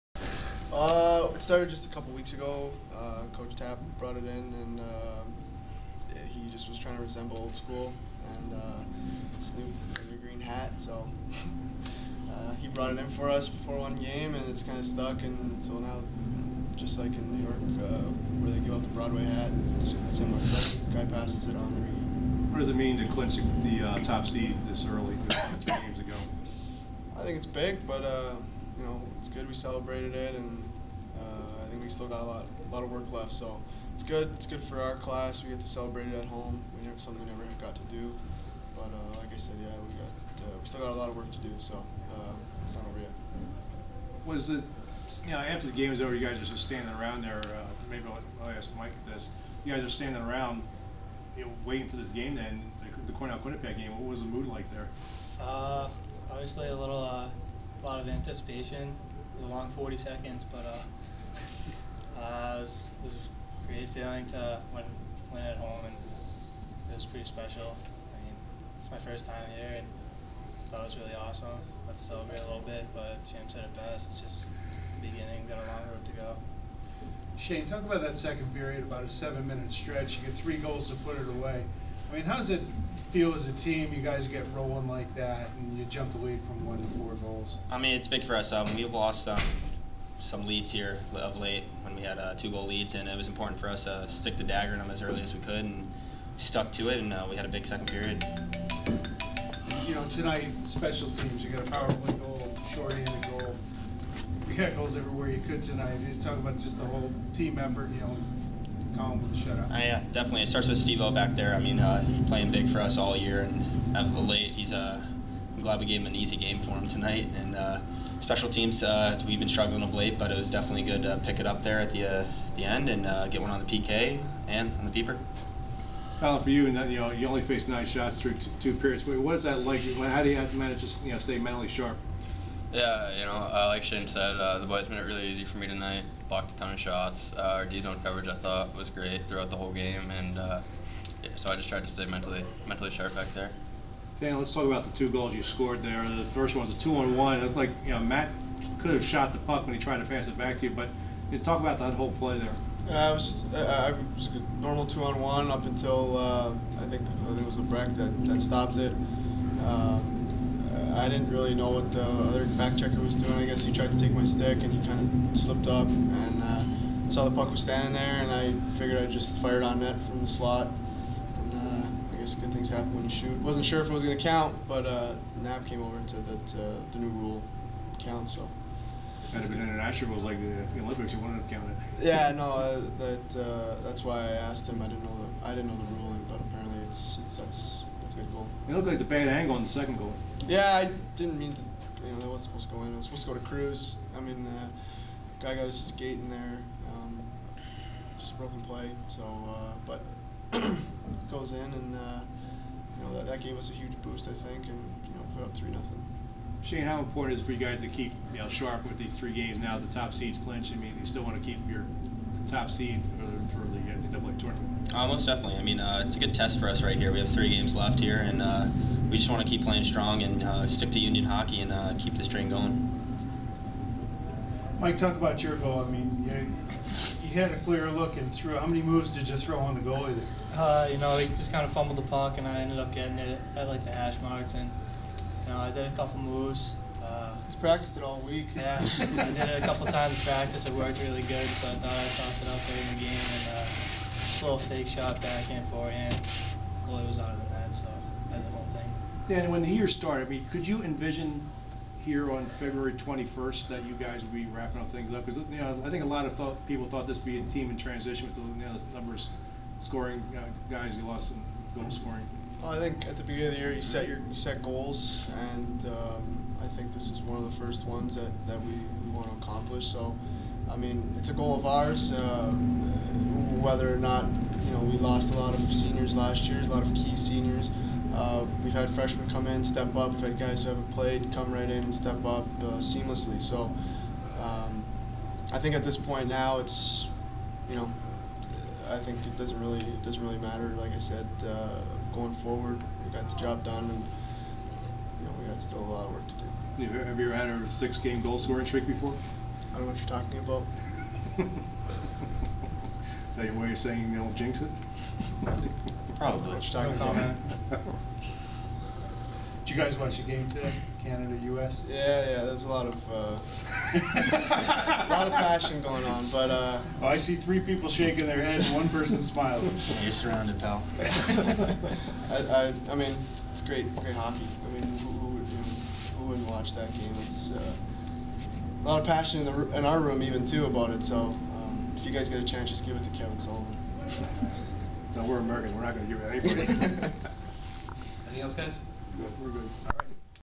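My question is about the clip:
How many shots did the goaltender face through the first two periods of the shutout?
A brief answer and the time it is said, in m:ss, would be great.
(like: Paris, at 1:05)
9, at 2:07.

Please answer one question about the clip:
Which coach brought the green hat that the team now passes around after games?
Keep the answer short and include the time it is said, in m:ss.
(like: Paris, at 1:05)
Coach Tapp, at 0:03.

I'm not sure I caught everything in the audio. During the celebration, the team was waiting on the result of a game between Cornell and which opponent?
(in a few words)
Quinnipiac.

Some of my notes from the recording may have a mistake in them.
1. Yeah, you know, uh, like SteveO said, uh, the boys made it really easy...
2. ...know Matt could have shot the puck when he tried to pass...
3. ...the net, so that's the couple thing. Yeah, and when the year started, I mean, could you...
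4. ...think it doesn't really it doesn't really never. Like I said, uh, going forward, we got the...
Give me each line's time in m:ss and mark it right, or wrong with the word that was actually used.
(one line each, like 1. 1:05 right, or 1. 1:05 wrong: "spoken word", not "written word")
1. 2:12 wrong: "Shayne", not "SteveO"
2. 2:27 right
3. 4:07 wrong: "whole", not "couple"
4. 4:48 wrong: "matter", not "never".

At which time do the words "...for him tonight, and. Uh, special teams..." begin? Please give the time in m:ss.
1:56.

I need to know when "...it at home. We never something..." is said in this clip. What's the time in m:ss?
0:36.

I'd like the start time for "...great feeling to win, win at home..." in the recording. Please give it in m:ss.
1:03.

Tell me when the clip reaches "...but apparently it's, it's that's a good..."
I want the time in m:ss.
3:06.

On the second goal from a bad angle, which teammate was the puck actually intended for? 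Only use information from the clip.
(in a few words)
Cruz.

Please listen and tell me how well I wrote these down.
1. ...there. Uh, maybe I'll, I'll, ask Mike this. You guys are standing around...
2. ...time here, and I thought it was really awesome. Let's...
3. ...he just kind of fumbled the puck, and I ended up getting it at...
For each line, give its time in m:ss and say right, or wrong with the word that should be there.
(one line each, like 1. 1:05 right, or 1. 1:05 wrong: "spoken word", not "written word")
1. 0:47 right
2. 1:09 right
3. 3:51 right.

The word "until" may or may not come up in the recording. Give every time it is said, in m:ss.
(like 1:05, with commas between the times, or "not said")
2:35.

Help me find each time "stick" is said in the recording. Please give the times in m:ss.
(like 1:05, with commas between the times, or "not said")
1:34, 2:44, 3:40.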